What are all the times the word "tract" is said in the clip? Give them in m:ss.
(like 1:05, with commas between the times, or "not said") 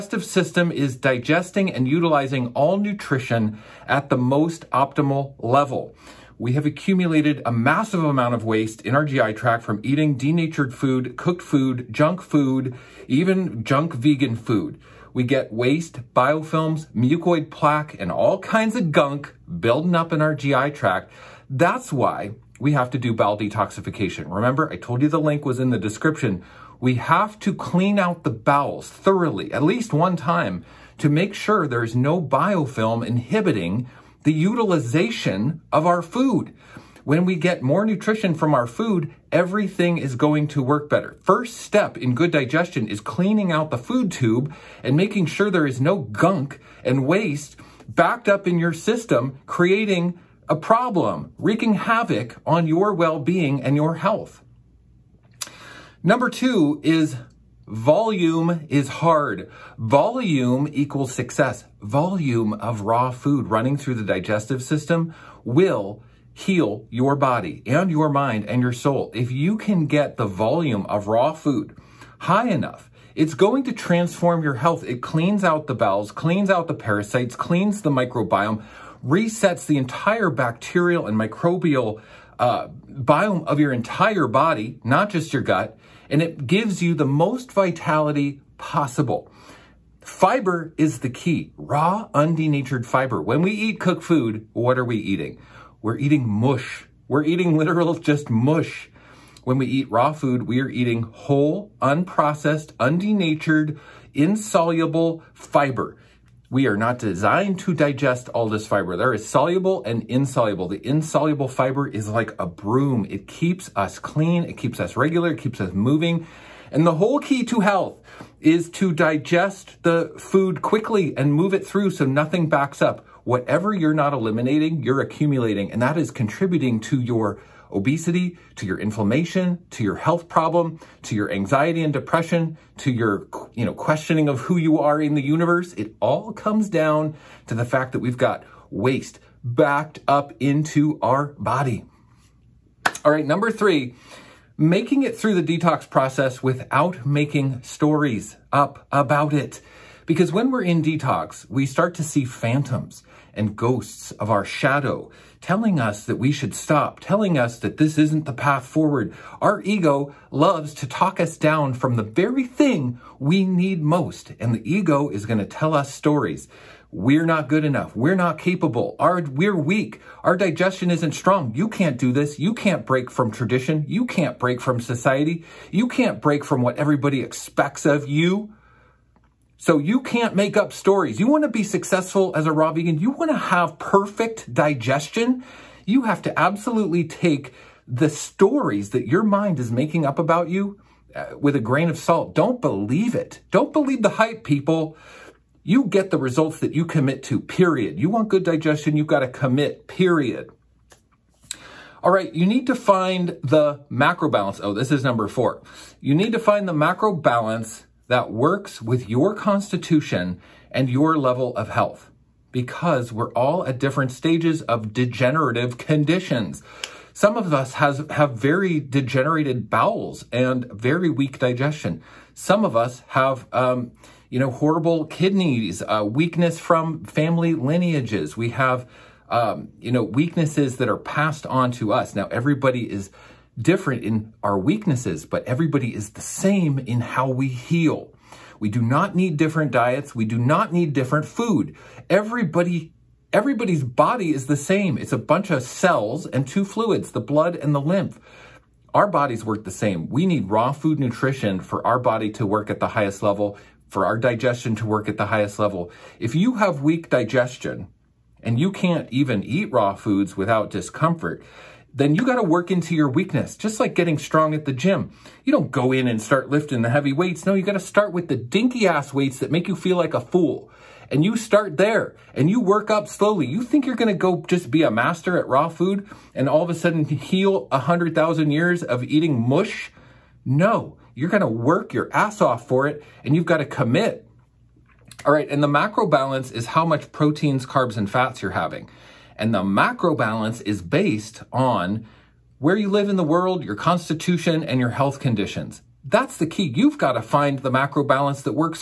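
0:09, 0:20.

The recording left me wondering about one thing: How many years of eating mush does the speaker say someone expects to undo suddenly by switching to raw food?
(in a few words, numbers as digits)
100,000.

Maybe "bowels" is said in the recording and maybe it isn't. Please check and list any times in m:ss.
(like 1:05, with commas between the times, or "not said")
0:23, 0:28, 1:15, 3:39.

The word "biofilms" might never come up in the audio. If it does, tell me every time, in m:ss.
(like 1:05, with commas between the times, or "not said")
0:16, 0:32.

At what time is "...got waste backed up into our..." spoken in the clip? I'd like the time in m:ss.
2:18.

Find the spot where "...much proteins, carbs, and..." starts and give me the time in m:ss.
4:46.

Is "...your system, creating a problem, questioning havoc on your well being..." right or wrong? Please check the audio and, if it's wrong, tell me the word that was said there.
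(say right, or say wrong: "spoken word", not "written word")
wrong: "wreaking", not "questioning".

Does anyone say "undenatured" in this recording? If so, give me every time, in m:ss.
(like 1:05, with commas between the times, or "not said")
1:32, 1:42.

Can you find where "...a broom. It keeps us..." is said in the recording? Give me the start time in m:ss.
1:52.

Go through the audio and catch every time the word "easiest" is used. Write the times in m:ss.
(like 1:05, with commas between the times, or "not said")
not said.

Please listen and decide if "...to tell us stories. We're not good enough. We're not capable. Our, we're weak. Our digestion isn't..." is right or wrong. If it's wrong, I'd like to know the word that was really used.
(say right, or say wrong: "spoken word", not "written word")
right.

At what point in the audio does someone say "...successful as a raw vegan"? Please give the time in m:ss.
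3:01.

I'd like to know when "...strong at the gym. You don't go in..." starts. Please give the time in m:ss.
4:24.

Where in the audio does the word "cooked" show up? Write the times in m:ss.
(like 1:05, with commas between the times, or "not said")
0:11, 1:33.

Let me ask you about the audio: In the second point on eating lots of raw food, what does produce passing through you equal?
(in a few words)
success.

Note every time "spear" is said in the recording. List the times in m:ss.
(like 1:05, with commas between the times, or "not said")
not said.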